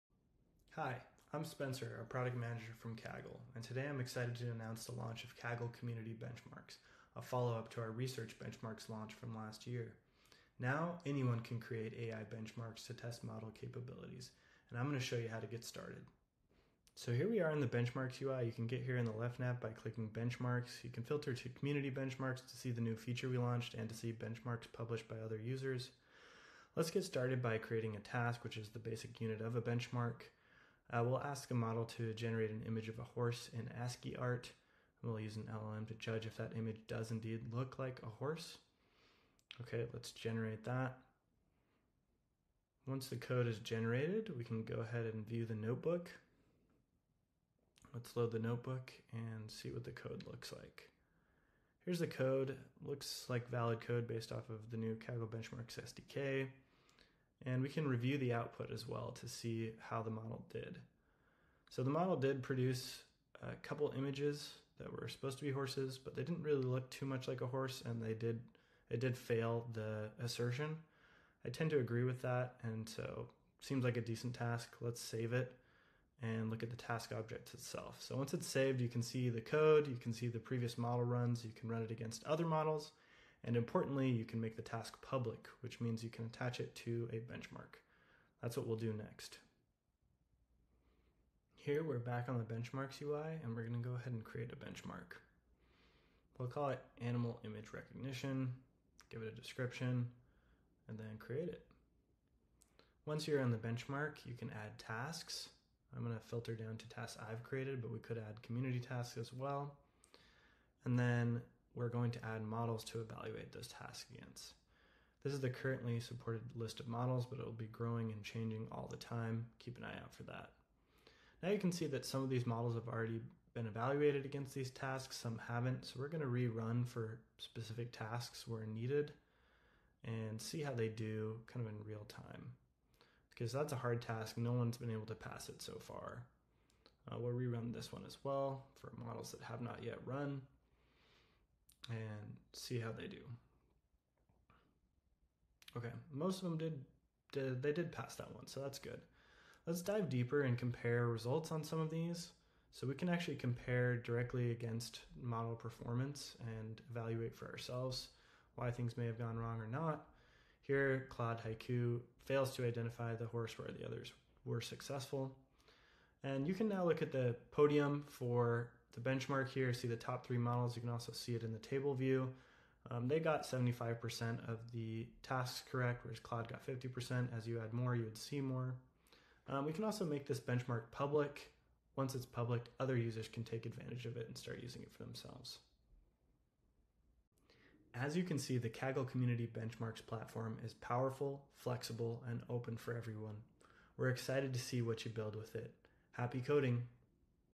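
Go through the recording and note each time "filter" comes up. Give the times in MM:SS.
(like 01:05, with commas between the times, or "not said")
00:21, 01:46.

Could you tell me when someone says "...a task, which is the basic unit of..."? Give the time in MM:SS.
00:27.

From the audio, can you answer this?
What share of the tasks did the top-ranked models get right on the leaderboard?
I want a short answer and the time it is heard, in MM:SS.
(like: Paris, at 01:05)
75%, at 02:53.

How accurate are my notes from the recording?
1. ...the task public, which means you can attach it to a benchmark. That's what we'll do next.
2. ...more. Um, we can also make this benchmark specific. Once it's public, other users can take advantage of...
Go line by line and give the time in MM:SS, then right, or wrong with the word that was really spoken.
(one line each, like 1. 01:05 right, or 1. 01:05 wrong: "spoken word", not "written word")
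1. 01:24 right
2. 02:58 wrong: "public", not "specific".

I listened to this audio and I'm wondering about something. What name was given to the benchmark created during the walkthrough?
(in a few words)
animal image recognition.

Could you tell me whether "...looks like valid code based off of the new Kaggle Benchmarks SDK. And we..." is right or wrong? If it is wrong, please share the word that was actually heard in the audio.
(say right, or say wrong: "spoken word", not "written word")
right.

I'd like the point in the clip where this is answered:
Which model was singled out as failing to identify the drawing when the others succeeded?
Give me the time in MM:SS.
02:41.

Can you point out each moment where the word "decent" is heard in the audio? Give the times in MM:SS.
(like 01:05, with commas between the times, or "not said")
01:14.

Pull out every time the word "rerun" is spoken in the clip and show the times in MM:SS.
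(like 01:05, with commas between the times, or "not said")
02:06, 02:17.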